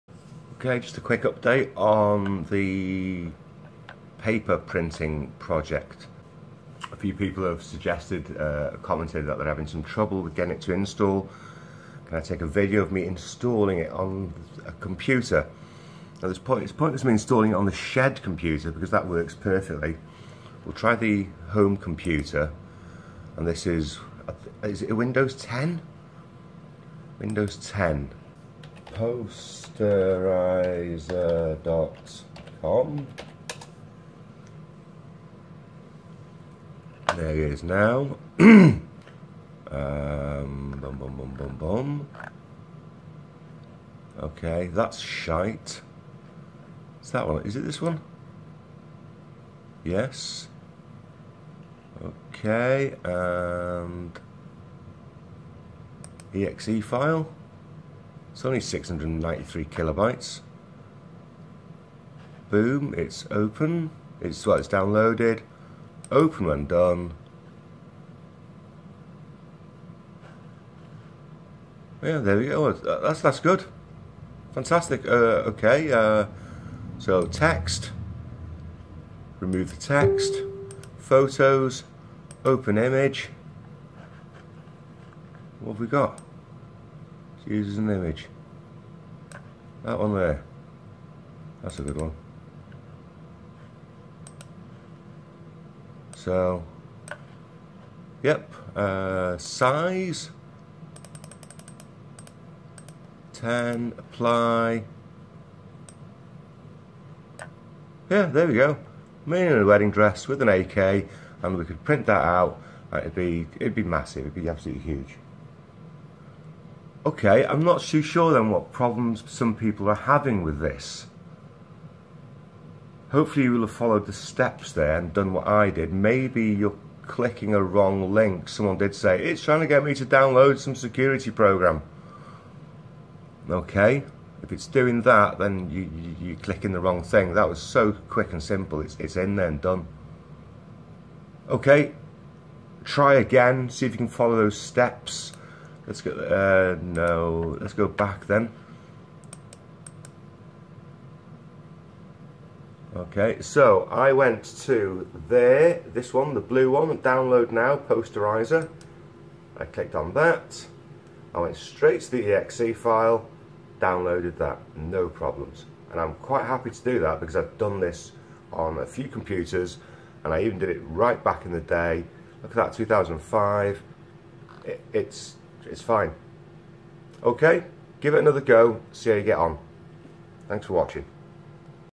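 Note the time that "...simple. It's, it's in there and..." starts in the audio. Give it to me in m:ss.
2:18.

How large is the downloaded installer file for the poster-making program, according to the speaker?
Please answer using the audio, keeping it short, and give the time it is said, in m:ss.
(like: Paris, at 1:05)
693 kilobytes, at 0:58.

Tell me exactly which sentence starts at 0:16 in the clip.
Now this point, it's pointless me installing it on the shed computer because that works perfectly.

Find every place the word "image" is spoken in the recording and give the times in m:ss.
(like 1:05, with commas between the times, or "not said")
1:22, 1:27.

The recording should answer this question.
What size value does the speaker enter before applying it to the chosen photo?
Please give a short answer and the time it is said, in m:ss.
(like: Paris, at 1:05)
10, at 1:43.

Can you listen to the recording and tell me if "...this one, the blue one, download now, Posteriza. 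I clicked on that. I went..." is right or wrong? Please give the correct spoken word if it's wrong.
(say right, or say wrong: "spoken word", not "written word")
right.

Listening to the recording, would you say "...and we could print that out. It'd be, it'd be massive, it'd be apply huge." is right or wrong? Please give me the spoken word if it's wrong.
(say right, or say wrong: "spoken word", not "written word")
wrong: "absolutely", not "apply".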